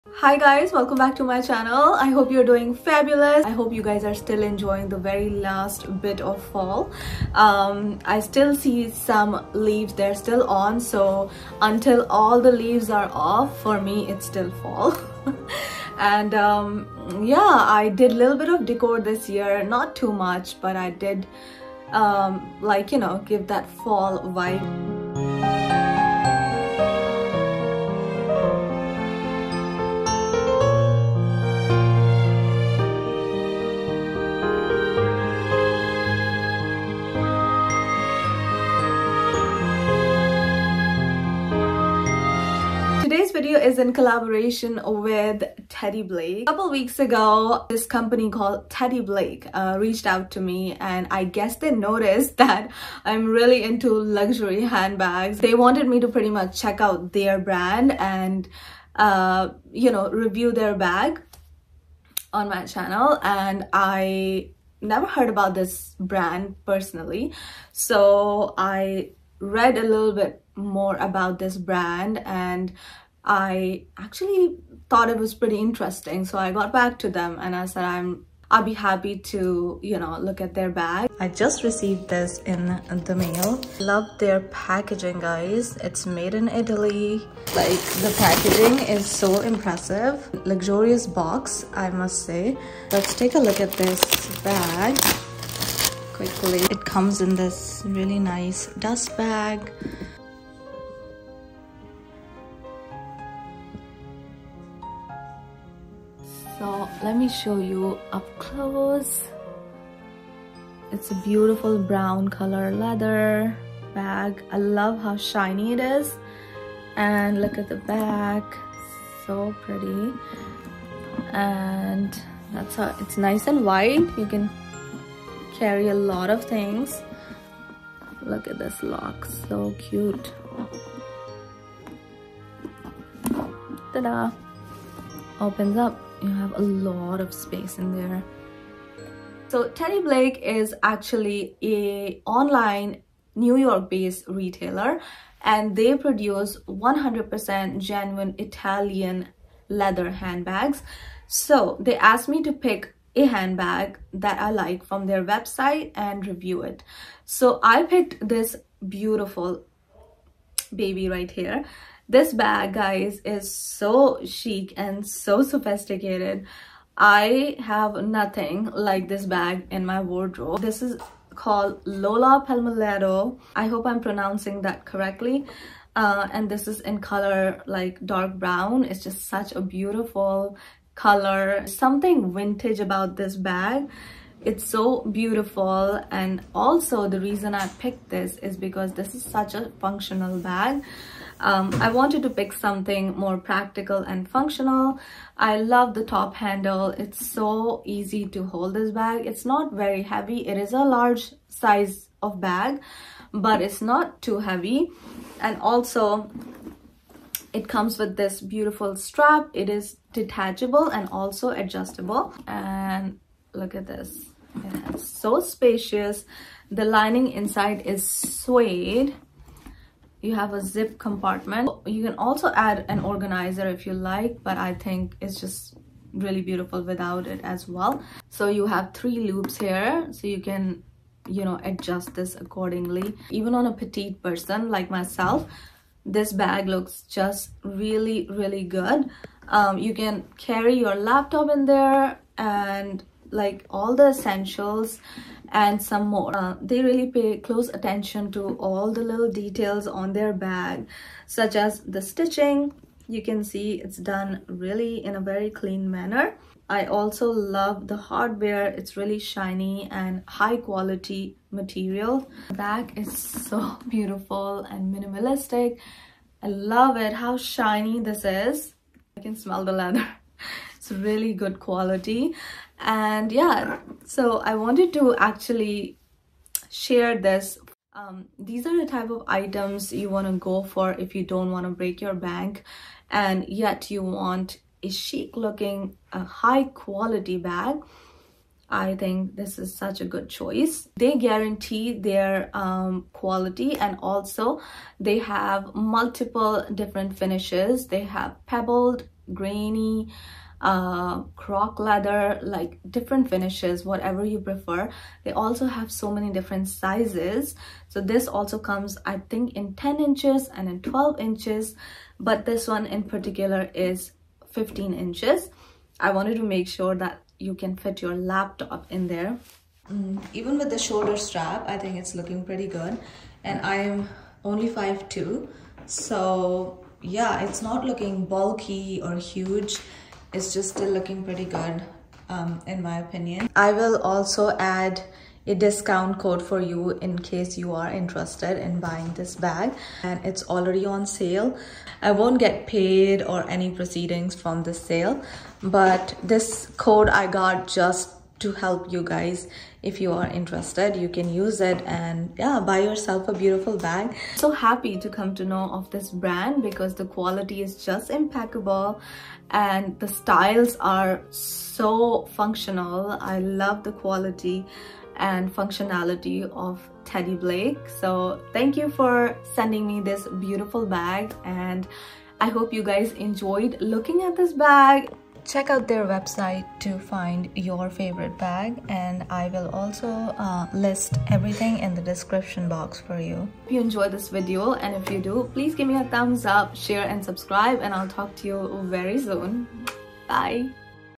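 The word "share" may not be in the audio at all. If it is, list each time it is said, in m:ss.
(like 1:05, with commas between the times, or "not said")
4:36, 6:26.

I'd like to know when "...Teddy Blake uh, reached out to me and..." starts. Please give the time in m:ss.
0:48.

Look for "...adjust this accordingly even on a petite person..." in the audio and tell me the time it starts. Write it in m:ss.
3:51.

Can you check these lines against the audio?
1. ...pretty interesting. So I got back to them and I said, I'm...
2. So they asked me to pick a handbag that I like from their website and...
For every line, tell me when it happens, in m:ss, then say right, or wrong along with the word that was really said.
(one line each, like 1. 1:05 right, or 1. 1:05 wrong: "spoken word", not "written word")
1. 1:15 right
2. 2:31 right.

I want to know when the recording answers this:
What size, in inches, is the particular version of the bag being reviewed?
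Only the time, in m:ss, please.
5:14.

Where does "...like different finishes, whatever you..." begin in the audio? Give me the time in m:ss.
5:02.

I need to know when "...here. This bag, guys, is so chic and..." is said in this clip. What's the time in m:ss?
2:41.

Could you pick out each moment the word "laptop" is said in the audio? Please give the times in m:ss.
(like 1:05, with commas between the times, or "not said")
4:00, 5:18.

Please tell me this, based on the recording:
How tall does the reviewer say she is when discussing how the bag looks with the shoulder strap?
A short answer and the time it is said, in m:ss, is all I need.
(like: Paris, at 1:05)
5'2", at 5:24.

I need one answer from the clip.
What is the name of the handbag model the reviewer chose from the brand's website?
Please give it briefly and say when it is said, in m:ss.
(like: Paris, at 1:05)
Lola Palmolero, at 2:51.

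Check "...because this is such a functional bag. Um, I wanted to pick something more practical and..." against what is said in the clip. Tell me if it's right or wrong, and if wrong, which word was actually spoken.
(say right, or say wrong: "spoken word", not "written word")
right.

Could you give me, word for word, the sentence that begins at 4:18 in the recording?
It's really shiny and high quality material.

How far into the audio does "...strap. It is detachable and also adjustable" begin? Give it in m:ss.
3:28.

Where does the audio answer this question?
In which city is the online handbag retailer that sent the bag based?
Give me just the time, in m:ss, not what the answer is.
2:23.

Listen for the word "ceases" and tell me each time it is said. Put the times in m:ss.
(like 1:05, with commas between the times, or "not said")
not said.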